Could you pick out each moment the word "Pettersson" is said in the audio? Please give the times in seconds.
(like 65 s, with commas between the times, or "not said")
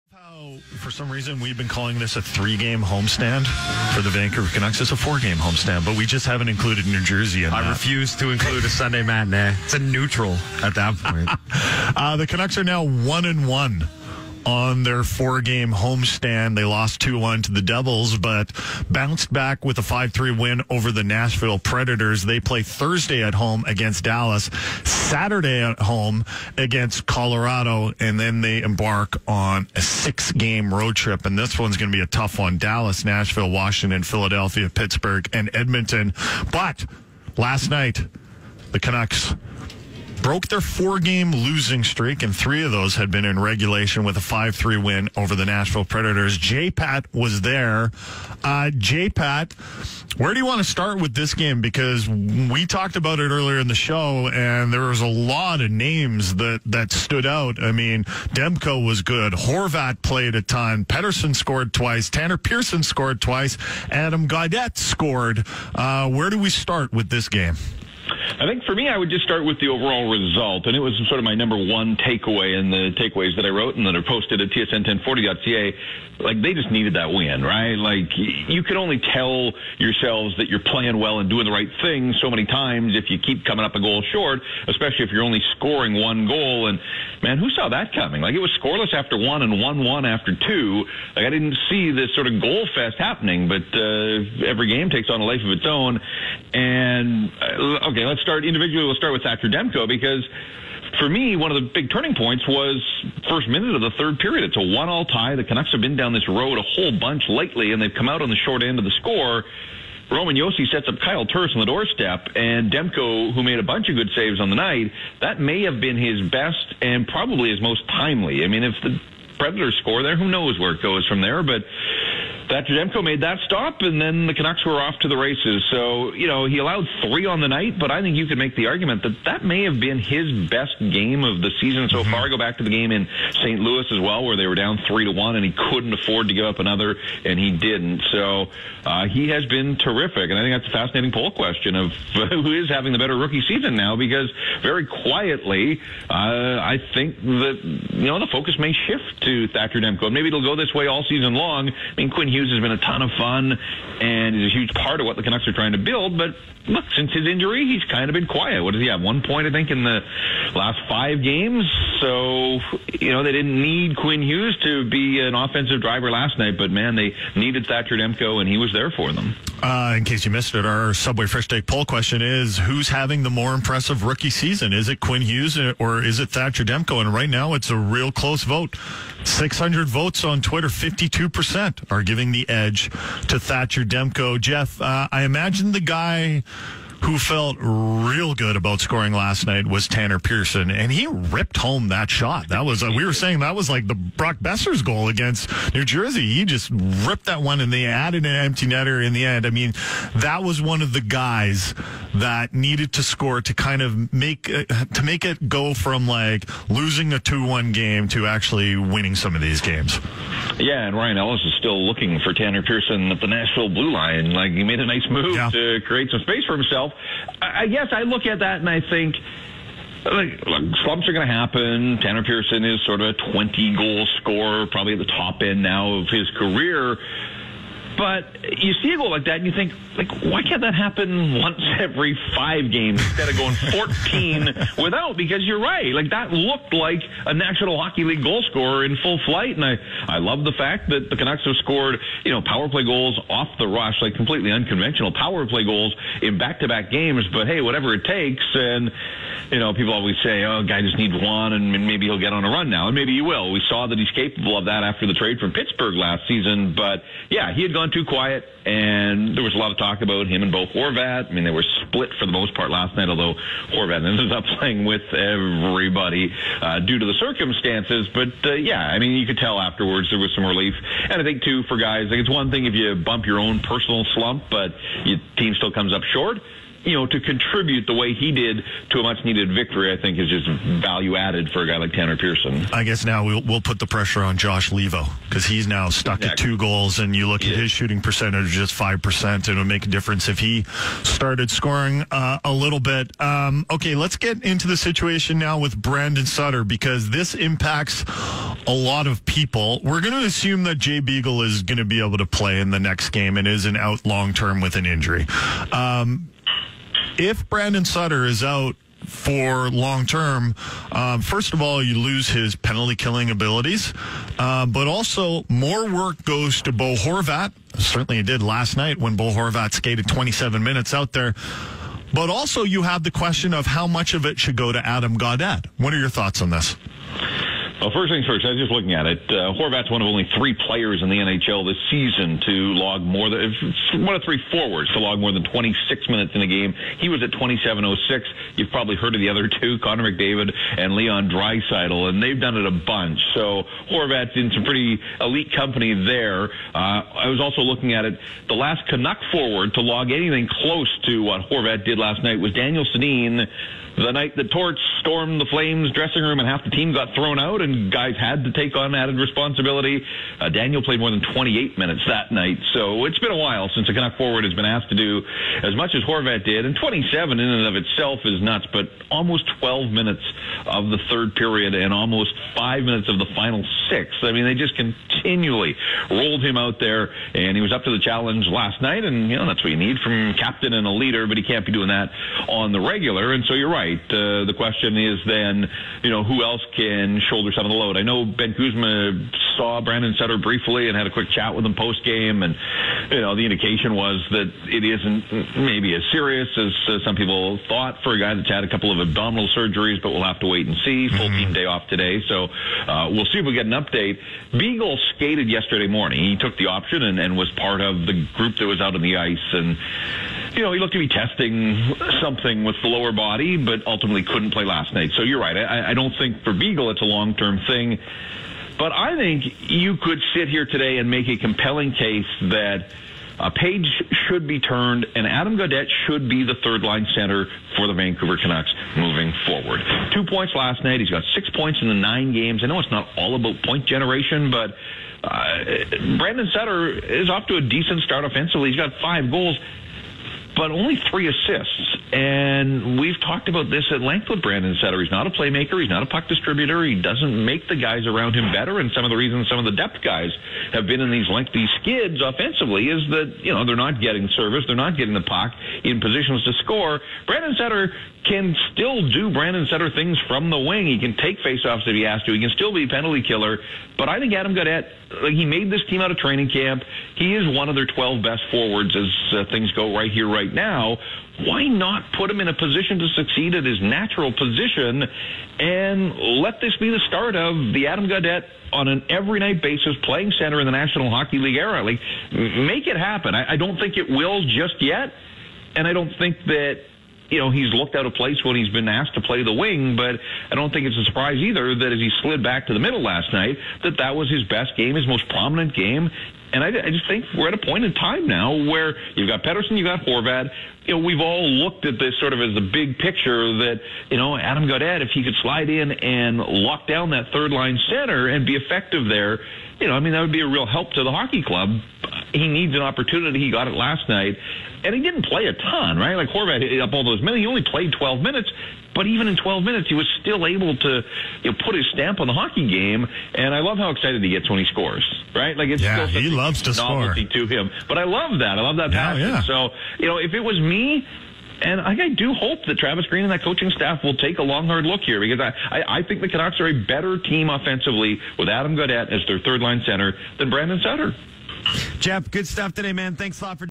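60 s, 499 s.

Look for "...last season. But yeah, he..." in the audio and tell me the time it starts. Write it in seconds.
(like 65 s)
255 s.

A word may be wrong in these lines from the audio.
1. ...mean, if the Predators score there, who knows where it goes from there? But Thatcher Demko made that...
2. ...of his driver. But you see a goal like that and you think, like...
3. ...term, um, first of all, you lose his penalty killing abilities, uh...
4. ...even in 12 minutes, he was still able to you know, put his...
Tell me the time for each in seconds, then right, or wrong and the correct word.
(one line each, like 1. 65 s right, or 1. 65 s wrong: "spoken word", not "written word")
1. 118 s right
2. 225 s wrong: "career", not "driver"
3. 310 s right
4. 519 s right.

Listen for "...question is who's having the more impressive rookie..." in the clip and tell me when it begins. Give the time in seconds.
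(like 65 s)
171 s.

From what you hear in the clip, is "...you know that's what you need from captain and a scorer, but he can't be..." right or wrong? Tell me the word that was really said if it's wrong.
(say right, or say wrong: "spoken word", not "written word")
wrong: "leader", not "scorer".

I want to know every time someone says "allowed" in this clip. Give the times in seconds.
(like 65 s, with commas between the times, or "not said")
126 s.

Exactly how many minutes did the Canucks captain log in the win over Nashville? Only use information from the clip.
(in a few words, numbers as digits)
27.06.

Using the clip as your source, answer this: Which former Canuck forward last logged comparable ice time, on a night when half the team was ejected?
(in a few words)
Daniel Sedin.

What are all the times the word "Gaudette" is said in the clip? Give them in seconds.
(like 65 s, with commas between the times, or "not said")
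64 s, 325 s, 425 s, 464 s, 478 s, 504 s, 538 s.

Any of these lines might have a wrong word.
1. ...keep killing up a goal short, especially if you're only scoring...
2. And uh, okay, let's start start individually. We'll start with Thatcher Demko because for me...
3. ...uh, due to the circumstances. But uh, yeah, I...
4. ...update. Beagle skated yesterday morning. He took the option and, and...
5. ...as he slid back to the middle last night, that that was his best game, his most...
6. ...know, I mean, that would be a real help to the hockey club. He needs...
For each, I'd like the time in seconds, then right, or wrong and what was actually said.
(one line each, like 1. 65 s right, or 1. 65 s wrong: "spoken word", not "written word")
1. 83 s wrong: "coming", not "killing"
2. 96 s right
3. 266 s right
4. 403 s right
5. 491 s right
6. 509 s right.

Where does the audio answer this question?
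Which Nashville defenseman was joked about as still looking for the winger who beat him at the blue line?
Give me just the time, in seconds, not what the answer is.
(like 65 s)
210 s.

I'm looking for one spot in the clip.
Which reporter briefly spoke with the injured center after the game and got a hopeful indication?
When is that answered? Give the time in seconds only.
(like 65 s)
388 s.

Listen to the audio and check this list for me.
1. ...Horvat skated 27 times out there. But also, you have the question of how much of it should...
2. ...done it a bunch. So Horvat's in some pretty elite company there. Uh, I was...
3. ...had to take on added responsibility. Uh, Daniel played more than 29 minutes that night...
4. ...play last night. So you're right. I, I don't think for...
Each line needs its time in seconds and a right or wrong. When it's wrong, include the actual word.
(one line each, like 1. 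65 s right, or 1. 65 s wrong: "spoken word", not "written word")
1. 319 s wrong: "minutes", not "times"
2. 342 s right
3. 358 s wrong: "28", not "29"
4. 414 s right.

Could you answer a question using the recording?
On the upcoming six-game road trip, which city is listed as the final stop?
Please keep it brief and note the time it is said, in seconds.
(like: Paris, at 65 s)
Edmonton, at 35 s.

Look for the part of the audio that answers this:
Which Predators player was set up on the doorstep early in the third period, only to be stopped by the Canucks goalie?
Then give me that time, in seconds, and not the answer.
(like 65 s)
110 s.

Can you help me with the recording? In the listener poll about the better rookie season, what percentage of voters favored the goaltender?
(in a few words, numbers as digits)
52%.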